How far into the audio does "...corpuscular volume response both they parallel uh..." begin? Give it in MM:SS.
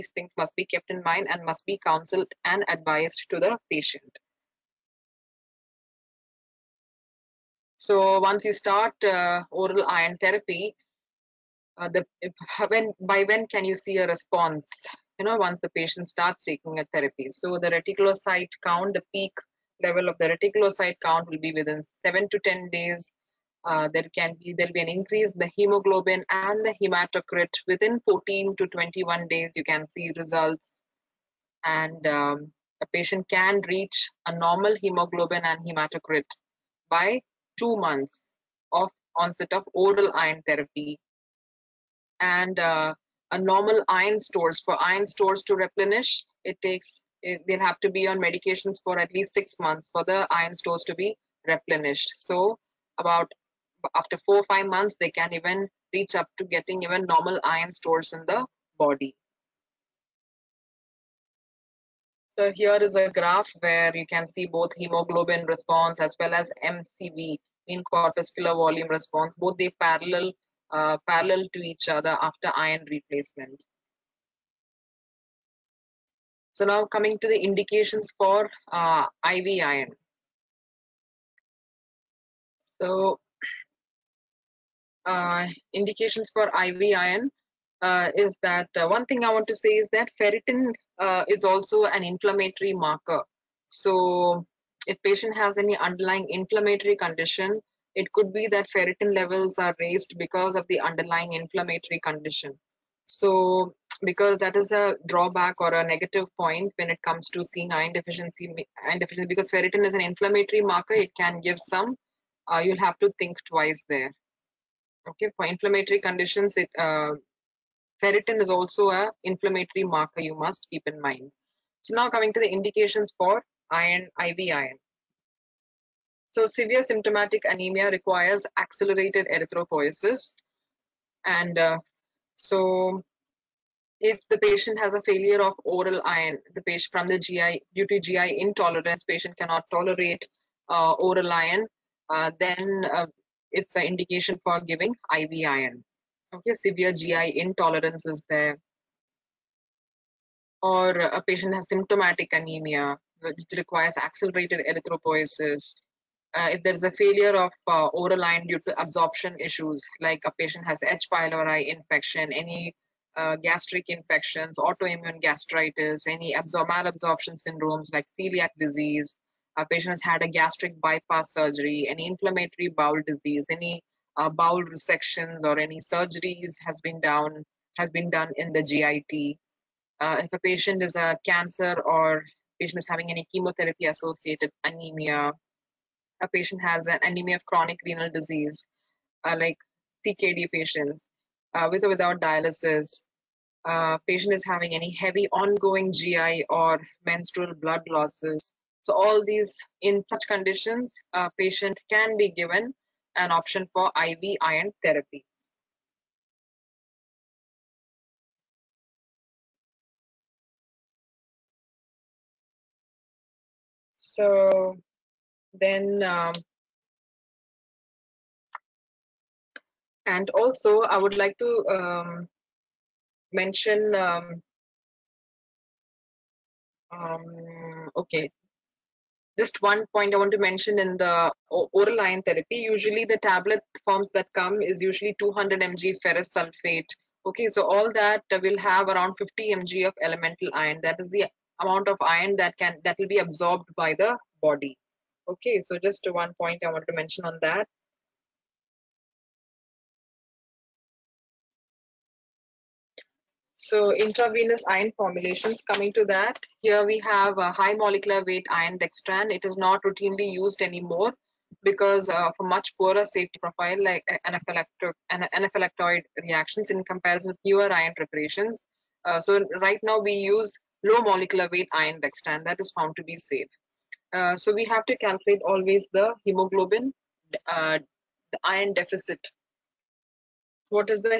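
01:07.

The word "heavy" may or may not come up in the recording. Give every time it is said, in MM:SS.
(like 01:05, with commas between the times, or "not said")
03:14.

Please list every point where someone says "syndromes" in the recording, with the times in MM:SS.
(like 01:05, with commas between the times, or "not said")
02:47.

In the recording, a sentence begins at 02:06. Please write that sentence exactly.
So severe symptomatic anemia requires accelerated erythropoiesis.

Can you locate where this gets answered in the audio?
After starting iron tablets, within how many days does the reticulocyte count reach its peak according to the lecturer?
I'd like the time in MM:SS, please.
00:22.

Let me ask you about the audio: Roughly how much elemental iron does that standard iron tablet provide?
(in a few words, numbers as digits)
50 mg.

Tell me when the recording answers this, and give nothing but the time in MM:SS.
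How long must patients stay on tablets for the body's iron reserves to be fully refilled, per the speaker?
00:48.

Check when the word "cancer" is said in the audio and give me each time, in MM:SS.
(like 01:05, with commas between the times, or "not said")
03:01.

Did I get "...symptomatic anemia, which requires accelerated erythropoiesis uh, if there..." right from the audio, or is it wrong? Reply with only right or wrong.
right.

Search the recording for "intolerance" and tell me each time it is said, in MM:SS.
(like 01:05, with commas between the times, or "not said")
02:18, 02:27.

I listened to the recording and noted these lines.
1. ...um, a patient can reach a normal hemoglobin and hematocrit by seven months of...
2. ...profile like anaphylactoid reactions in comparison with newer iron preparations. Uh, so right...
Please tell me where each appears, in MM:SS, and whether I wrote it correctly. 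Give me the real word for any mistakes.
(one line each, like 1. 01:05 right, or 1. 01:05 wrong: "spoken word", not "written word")
1. 00:32 wrong: "two", not "seven"
2. 04:23 right.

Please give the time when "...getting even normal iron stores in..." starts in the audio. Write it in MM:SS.
00:56.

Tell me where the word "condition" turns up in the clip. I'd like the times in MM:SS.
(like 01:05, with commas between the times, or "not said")
01:36, 01:42, 01:55, 03:20.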